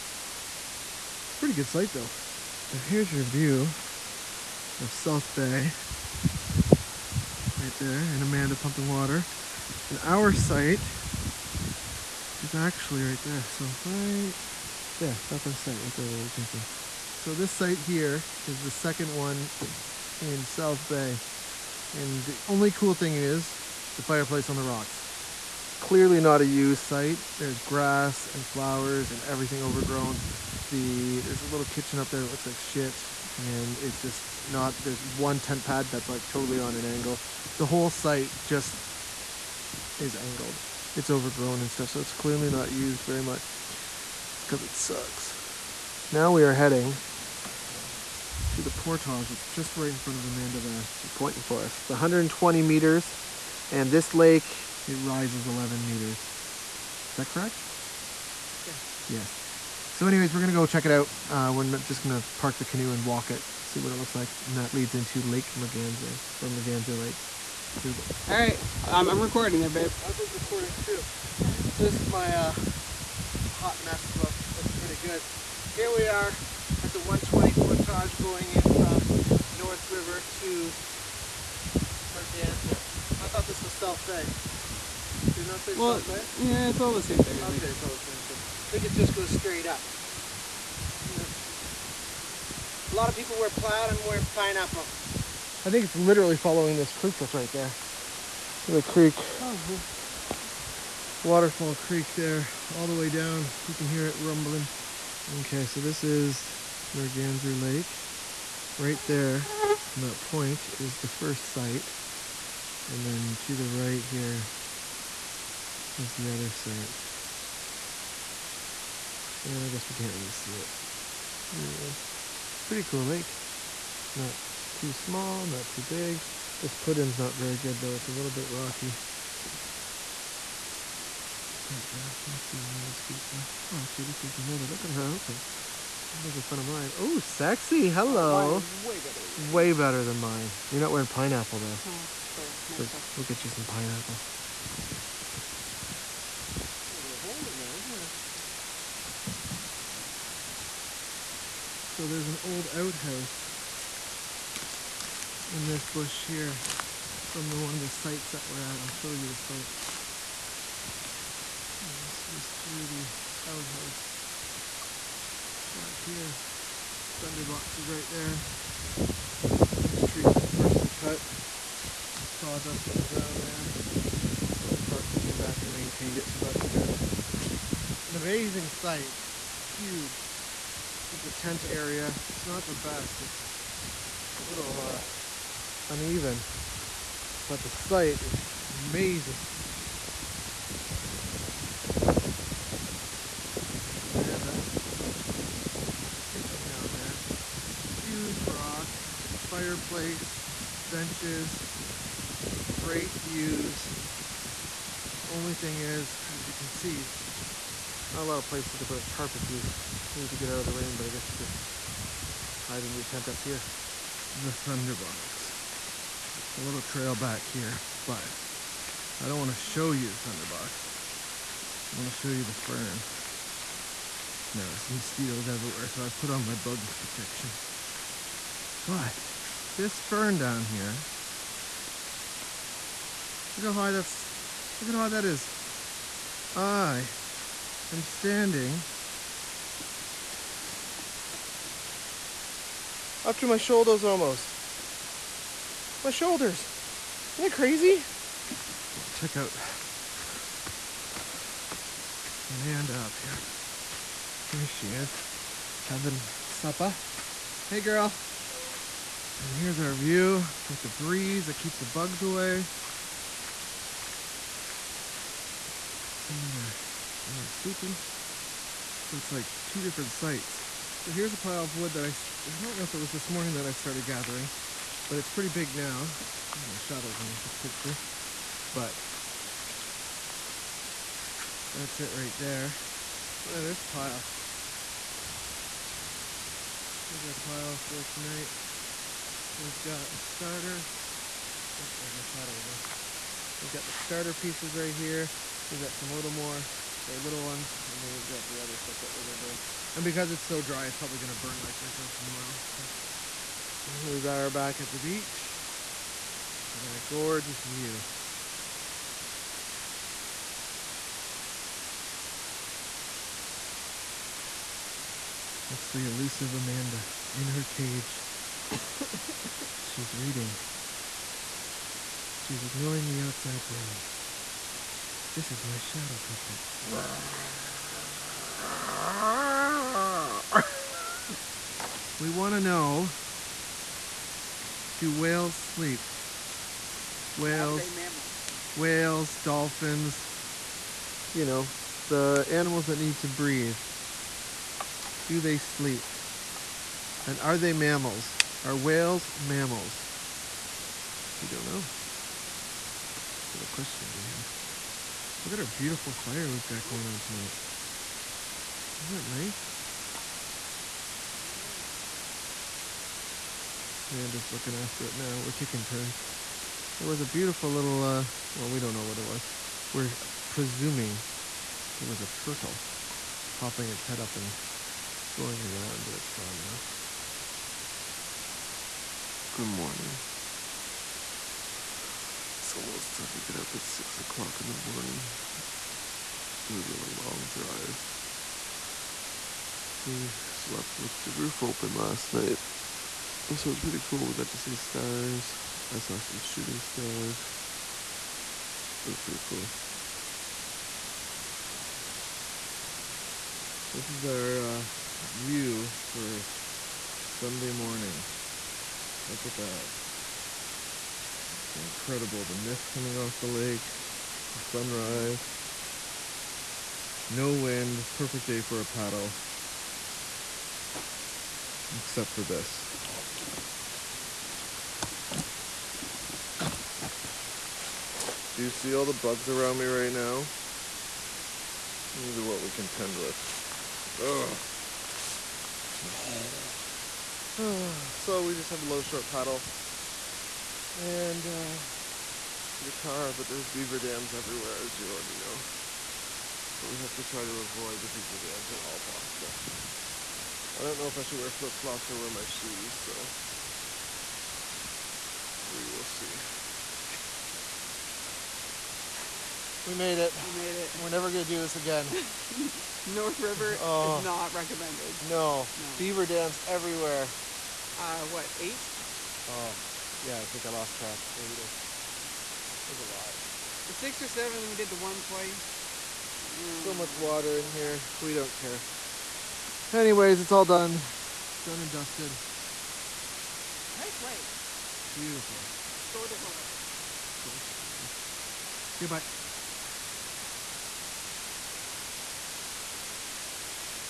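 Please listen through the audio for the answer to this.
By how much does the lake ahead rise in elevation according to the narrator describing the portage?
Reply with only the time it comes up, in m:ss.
0:55.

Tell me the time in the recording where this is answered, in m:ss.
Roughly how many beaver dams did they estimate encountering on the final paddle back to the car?
7:48.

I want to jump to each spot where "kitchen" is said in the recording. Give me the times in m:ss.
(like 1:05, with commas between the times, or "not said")
0:31, 3:16.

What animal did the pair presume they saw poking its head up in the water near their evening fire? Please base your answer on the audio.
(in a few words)
A turtle.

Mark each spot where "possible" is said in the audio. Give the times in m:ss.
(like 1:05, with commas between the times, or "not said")
7:28.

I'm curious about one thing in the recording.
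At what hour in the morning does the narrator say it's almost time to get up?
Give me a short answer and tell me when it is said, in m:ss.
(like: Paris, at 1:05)
6 o'clock, at 6:23.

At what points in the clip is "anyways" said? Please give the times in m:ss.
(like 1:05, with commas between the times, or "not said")
1:00, 2:01, 7:59.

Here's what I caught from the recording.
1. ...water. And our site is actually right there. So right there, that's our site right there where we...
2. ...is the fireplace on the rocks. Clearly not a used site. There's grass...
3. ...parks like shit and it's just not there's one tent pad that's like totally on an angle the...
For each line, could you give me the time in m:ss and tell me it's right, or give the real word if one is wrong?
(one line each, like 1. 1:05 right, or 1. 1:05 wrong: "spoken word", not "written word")
1. 0:08 right
2. 0:23 right
3. 0:32 wrong: "looks", not "parks".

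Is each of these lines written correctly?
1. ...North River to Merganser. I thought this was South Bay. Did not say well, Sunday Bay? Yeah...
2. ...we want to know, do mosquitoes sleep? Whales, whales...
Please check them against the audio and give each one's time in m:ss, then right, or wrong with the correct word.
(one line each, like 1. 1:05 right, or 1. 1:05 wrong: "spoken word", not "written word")
1. 1:19 wrong: "South", not "Sunday"
2. 5:32 wrong: "whales", not "mosquitoes".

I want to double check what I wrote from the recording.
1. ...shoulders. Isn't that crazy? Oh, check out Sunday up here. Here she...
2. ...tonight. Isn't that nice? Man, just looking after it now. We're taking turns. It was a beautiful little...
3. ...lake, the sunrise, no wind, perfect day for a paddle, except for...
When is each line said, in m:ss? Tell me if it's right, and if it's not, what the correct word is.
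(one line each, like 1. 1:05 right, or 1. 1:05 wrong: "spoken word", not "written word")
1. 4:06 wrong: "Amanda", not "Sunday"
2. 5:57 right
3. 6:53 right.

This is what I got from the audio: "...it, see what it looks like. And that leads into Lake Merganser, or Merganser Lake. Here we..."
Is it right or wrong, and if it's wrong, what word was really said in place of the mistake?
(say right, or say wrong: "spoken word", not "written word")
right.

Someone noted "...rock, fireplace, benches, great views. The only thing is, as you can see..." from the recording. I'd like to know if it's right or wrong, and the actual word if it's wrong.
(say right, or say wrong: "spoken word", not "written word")
right.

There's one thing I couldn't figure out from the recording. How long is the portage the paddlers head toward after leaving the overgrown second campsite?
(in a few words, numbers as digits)
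120 meters.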